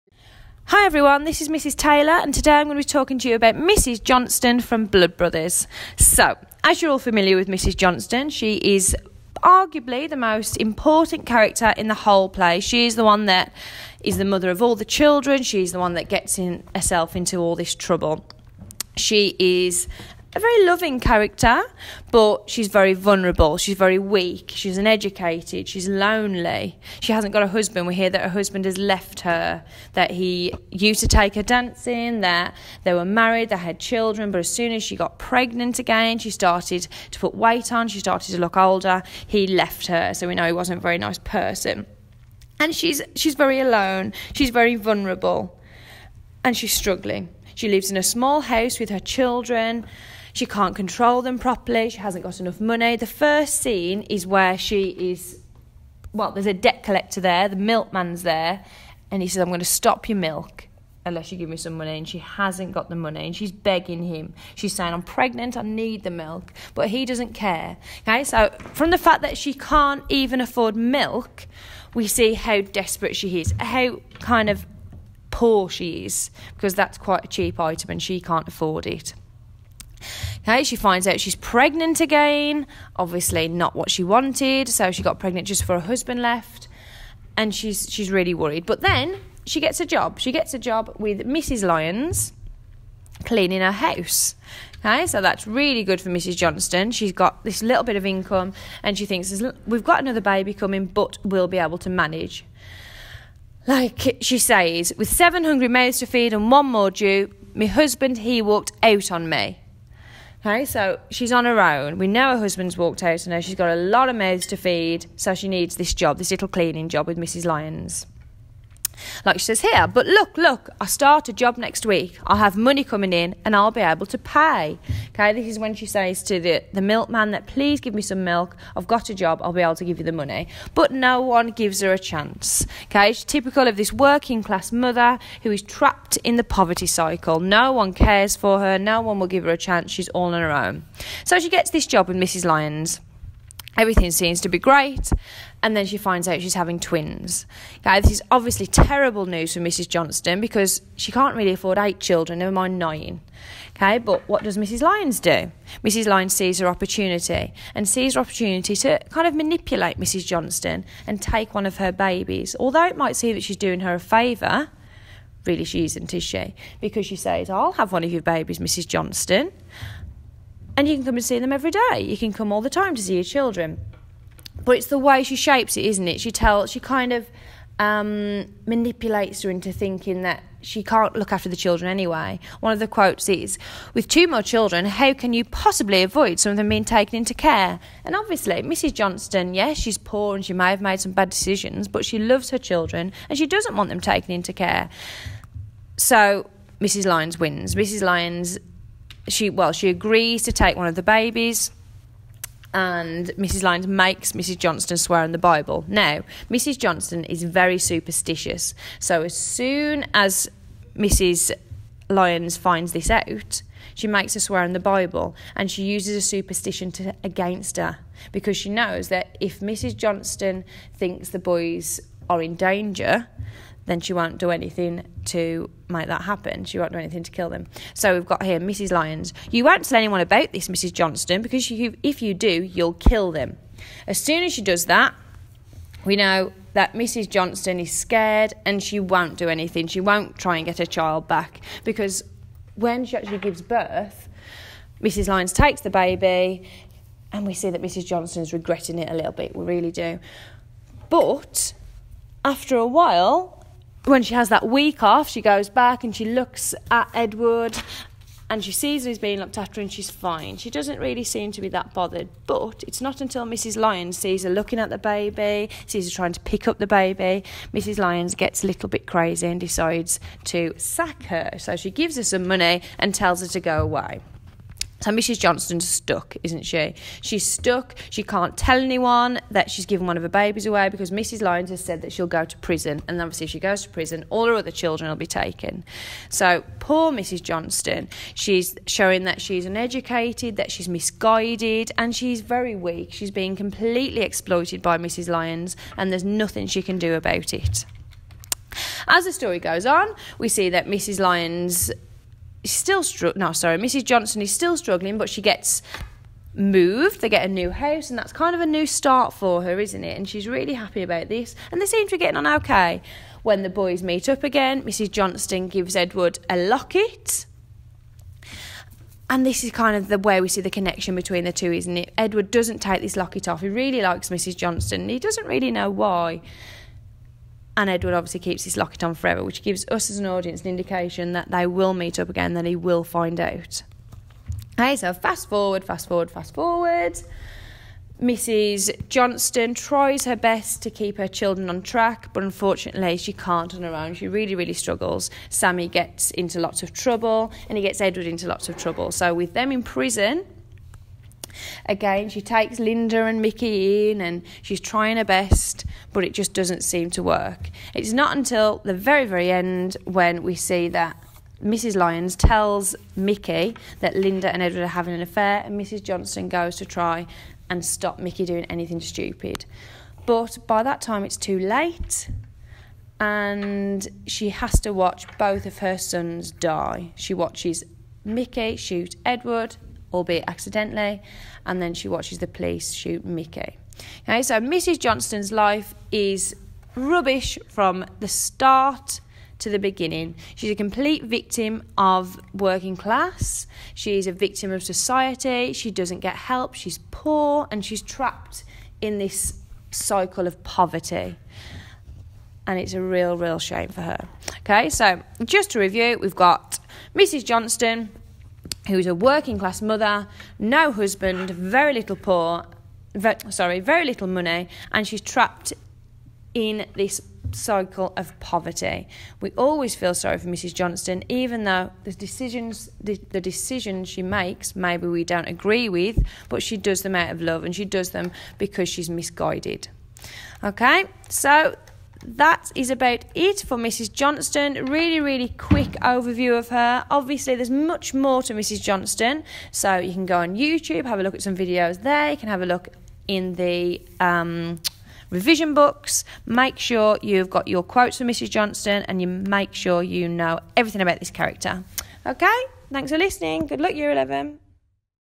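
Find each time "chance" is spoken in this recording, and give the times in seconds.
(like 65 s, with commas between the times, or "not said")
131 s, 139 s.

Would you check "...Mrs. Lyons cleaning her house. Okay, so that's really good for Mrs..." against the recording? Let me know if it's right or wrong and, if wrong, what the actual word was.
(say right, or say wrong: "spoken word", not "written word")
right.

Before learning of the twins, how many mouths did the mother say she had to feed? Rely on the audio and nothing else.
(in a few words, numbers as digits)
7.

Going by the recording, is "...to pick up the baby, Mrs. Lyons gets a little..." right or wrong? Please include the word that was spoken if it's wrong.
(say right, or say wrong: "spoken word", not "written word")
right.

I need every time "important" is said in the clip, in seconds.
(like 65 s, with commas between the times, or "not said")
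10 s.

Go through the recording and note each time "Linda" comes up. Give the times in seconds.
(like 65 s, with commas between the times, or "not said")
352 s, 364 s.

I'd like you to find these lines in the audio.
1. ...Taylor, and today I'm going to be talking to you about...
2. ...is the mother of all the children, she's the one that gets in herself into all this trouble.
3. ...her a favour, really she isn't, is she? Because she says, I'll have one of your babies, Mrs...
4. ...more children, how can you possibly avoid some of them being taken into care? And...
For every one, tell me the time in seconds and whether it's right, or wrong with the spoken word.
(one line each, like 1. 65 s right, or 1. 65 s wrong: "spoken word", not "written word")
1. 1 s right
2. 14 s right
3. 163 s right
4. 184 s right.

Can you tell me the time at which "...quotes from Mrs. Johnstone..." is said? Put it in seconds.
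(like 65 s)
447 s.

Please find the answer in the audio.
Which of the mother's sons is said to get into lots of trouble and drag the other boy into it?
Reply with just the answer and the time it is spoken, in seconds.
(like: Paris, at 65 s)
Sammy, at 345 s.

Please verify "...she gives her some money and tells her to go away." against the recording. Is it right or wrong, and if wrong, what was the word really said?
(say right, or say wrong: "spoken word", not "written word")
right.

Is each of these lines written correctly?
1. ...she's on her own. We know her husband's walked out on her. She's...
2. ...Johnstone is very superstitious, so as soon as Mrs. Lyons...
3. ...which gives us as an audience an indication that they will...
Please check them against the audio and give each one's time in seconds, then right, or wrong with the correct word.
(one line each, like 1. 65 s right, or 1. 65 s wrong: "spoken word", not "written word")
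1. 111 s right
2. 206 s right
3. 329 s right.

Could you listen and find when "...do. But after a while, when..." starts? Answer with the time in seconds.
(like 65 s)
249 s.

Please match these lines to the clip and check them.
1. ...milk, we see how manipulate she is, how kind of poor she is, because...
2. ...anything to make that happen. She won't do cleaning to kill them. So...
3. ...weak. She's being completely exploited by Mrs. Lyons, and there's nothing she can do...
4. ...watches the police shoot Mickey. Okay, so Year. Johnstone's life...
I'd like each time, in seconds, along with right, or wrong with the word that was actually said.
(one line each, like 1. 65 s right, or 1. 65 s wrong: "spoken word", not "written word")
1. 70 s wrong: "desperate", not "manipulate"
2. 224 s wrong: "anything", not "cleaning"
3. 292 s right
4. 382 s wrong: "Mrs", not "Year".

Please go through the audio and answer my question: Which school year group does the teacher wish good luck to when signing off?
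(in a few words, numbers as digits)
Year 11.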